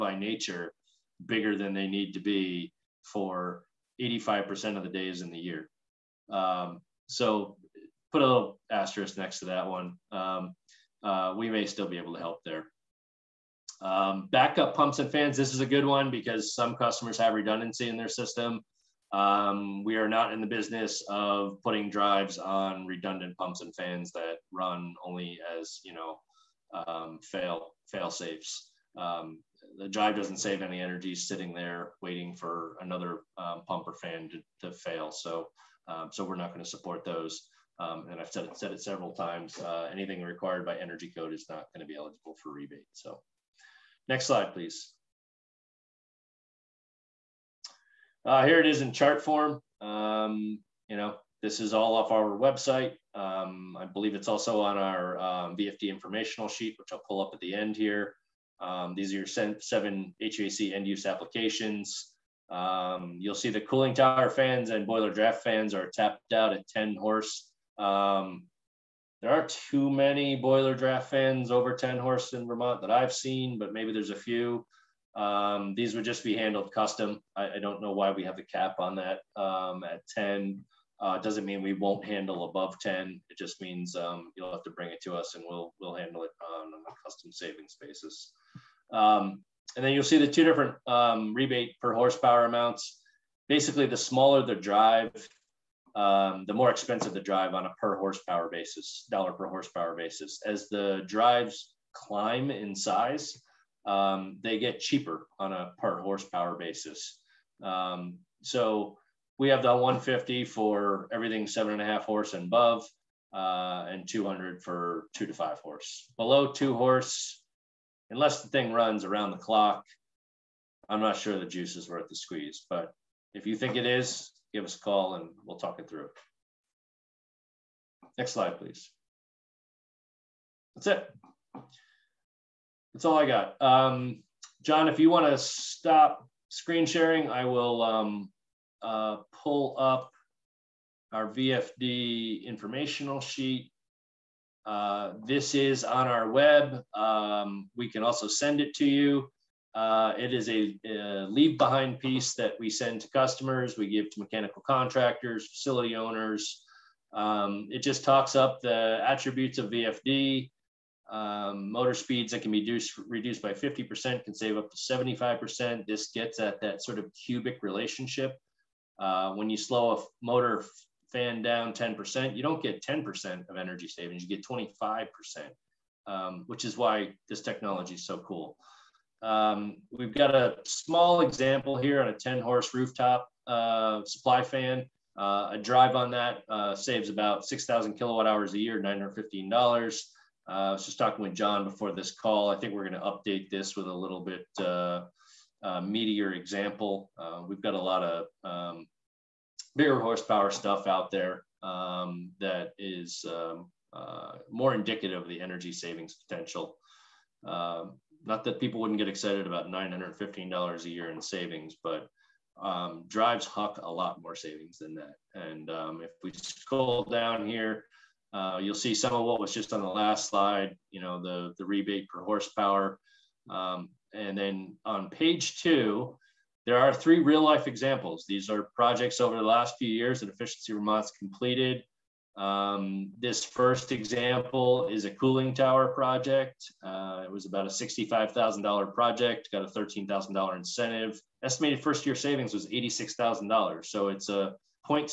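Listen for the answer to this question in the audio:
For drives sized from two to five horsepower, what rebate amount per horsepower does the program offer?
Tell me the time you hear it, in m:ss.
1:54.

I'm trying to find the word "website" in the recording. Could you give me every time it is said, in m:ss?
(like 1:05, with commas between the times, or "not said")
0:52.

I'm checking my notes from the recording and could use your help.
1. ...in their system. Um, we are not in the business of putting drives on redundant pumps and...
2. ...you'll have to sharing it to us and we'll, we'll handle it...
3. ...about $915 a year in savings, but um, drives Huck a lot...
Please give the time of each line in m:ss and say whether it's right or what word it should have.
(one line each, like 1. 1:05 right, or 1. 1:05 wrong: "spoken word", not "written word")
1. 0:17 right
2. 1:24 wrong: "bring", not "sharing"
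3. 3:29 right.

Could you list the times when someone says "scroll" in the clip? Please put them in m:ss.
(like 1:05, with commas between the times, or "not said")
3:36.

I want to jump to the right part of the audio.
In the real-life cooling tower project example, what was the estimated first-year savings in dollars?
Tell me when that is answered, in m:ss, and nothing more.
4:02.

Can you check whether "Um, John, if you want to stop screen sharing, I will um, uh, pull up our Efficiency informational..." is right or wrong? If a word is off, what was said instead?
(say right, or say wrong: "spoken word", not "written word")
wrong: "VFD", not "Efficiency".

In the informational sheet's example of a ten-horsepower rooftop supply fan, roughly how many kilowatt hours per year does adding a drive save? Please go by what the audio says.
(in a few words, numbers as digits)
6,000.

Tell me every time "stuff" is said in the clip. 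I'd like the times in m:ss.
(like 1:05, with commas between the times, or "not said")
3:20.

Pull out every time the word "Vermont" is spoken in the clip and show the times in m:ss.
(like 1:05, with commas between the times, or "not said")
1:12, 3:50.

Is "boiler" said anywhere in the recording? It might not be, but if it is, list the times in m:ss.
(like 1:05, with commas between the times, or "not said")
1:04, 1:10.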